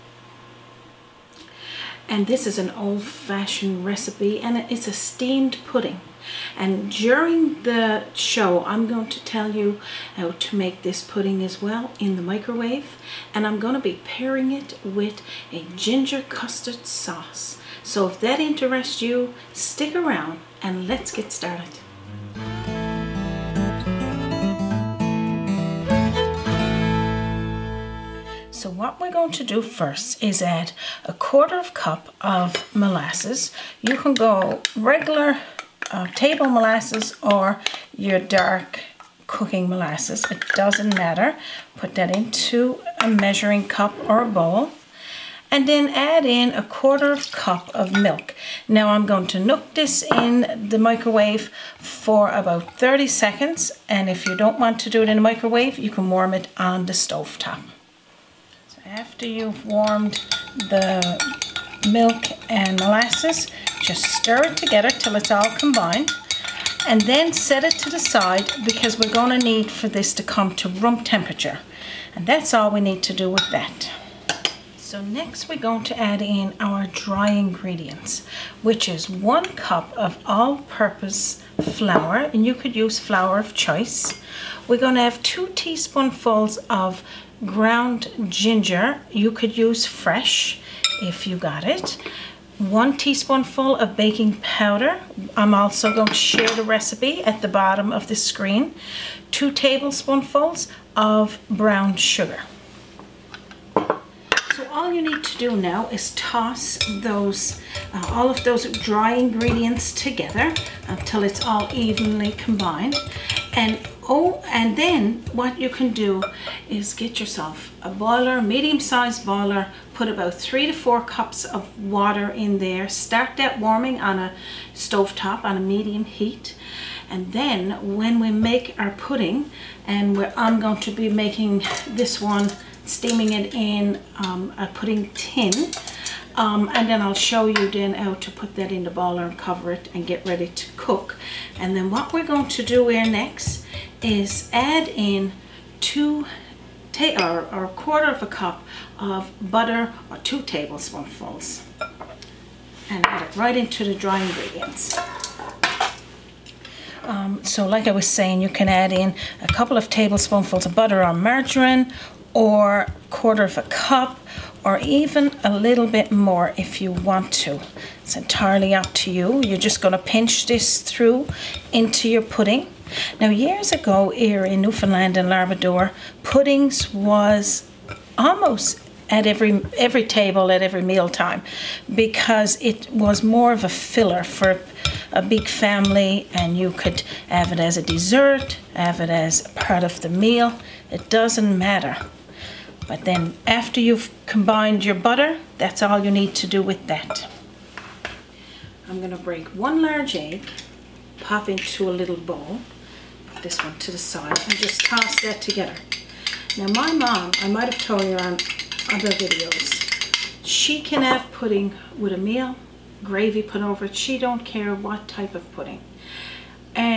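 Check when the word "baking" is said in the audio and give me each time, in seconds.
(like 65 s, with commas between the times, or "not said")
93 s.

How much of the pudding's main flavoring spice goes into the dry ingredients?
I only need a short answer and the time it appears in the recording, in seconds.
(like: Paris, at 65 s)
2 teaspoons, at 85 s.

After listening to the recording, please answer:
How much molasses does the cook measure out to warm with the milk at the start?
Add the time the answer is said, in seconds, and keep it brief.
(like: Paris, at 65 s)
1/4 cup, at 31 s.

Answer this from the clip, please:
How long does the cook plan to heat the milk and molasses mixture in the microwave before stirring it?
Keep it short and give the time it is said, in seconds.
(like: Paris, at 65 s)
30 seconds, at 52 s.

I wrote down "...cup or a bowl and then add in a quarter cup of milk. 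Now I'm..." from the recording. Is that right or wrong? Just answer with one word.
right.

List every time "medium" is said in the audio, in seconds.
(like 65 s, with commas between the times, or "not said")
118 s, 125 s.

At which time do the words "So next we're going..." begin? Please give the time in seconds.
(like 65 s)
74 s.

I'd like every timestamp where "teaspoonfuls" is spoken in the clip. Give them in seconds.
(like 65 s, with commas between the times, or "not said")
85 s, 92 s.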